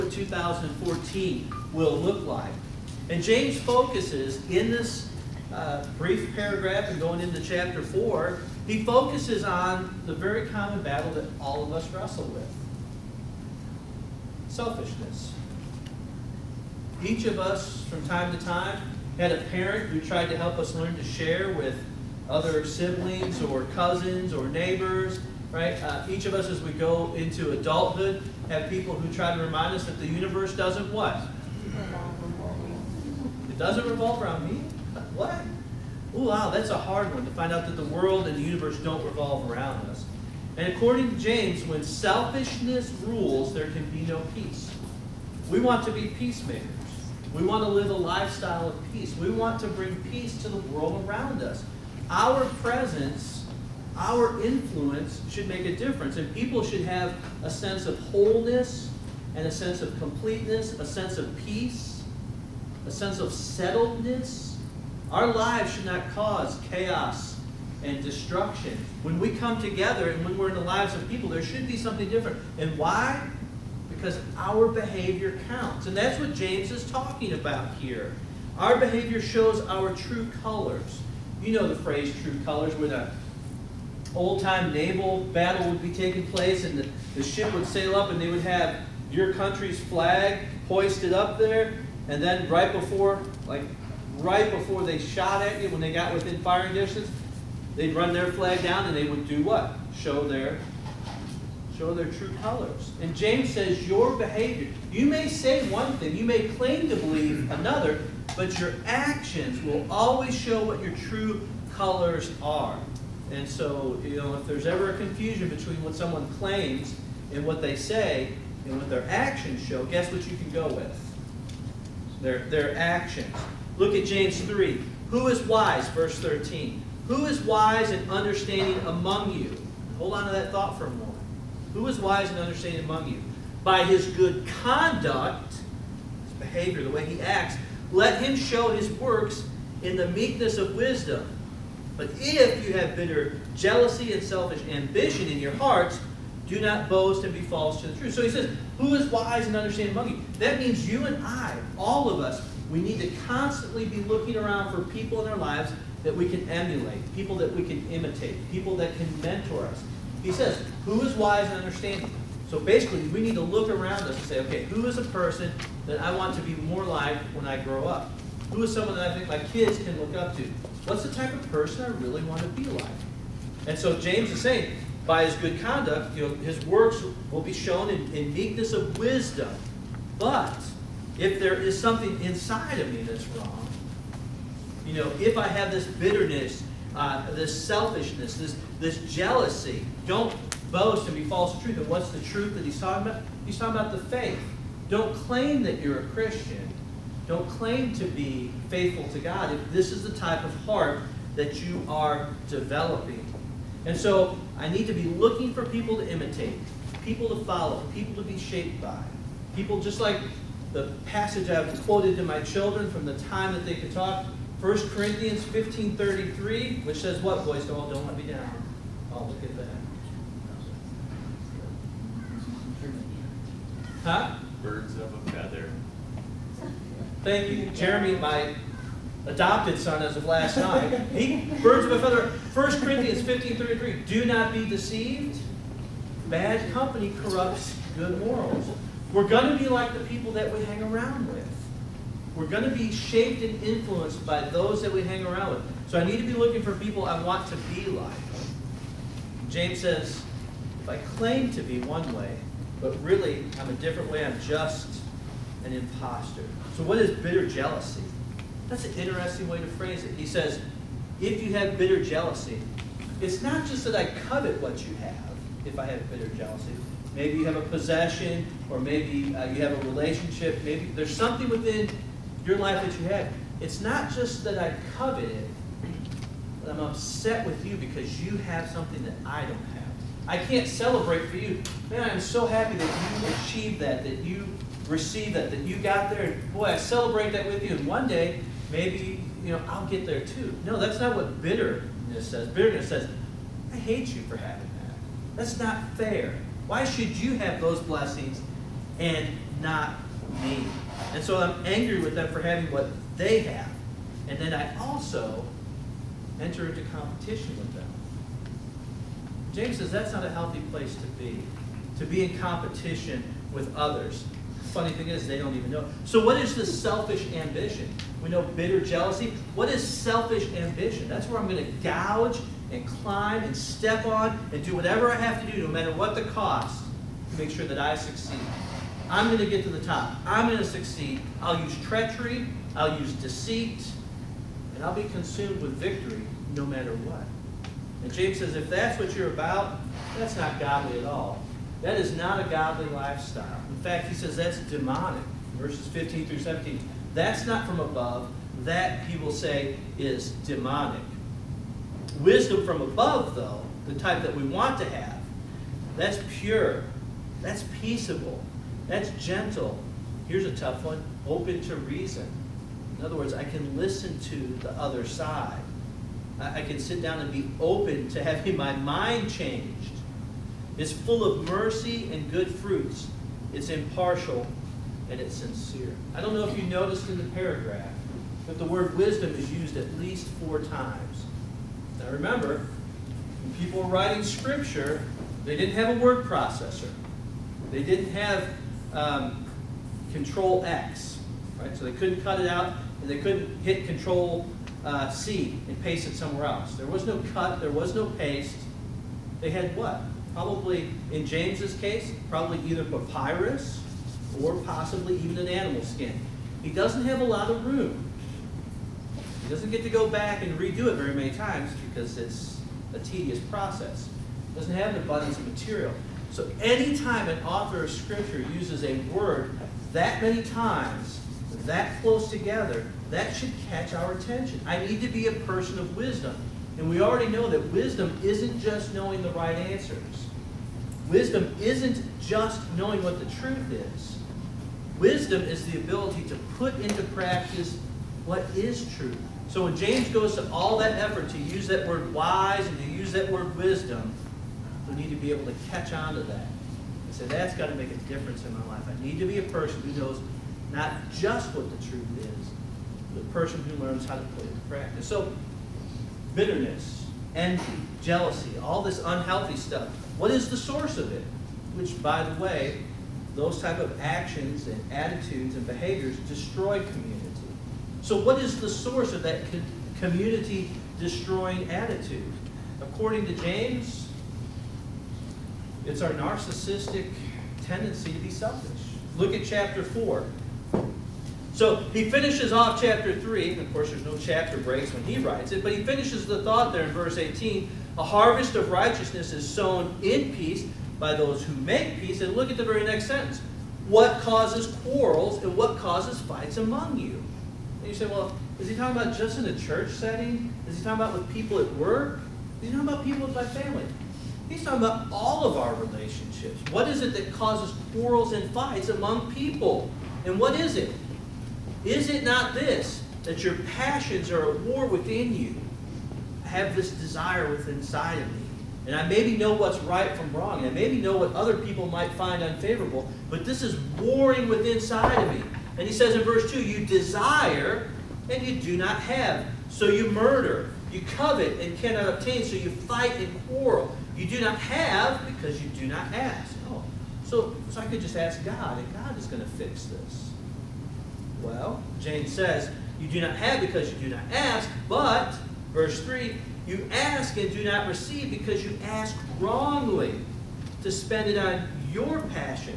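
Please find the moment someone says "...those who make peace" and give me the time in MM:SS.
08:11.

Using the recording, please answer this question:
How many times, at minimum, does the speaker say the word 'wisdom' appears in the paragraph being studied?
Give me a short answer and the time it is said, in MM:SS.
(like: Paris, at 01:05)
4, at 06:20.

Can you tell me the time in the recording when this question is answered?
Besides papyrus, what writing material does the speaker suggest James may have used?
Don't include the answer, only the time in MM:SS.
06:45.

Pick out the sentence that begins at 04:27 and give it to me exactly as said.
Maybe you have a possession, or maybe uh, you have a relationship.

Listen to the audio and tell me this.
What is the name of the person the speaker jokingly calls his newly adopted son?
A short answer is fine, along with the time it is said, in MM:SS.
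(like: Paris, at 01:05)
Jeremy, at 03:47.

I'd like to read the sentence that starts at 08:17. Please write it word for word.
And you say, Well, is he talking about just in a church setting?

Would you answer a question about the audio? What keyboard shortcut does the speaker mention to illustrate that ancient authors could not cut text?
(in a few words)
Control X.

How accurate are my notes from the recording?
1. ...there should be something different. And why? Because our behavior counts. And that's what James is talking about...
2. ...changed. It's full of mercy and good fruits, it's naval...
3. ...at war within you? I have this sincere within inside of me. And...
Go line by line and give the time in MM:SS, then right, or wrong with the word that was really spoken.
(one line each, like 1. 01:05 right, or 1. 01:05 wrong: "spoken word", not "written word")
1. 01:11 right
2. 06:09 wrong: "impartial", not "naval"
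3. 08:34 wrong: "desire", not "sincere".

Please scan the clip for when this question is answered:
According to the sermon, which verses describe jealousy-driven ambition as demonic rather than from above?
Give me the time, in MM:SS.
05:45.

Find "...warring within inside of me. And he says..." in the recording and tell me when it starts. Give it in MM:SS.
08:43.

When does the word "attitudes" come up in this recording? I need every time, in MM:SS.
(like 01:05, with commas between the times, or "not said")
07:44, 07:51.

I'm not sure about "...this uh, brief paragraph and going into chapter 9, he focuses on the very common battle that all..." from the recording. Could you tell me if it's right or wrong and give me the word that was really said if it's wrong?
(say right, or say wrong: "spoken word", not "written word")
wrong: "4", not "9".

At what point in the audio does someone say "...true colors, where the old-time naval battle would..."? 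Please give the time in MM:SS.
01:22.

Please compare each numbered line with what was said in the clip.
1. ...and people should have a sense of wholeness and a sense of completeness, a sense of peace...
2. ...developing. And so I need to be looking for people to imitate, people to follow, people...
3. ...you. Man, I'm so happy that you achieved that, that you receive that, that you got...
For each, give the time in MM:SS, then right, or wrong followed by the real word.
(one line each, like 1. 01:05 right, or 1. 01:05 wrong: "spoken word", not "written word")
1. 00:56 right
2. 03:22 right
3. 04:41 right.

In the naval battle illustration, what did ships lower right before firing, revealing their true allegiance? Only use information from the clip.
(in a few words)
their flag.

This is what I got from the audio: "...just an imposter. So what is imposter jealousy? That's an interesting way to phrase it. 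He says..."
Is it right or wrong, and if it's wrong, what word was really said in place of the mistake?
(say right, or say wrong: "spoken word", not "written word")
wrong: "bitter", not "imposter".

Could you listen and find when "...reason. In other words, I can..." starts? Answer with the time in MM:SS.
06:01.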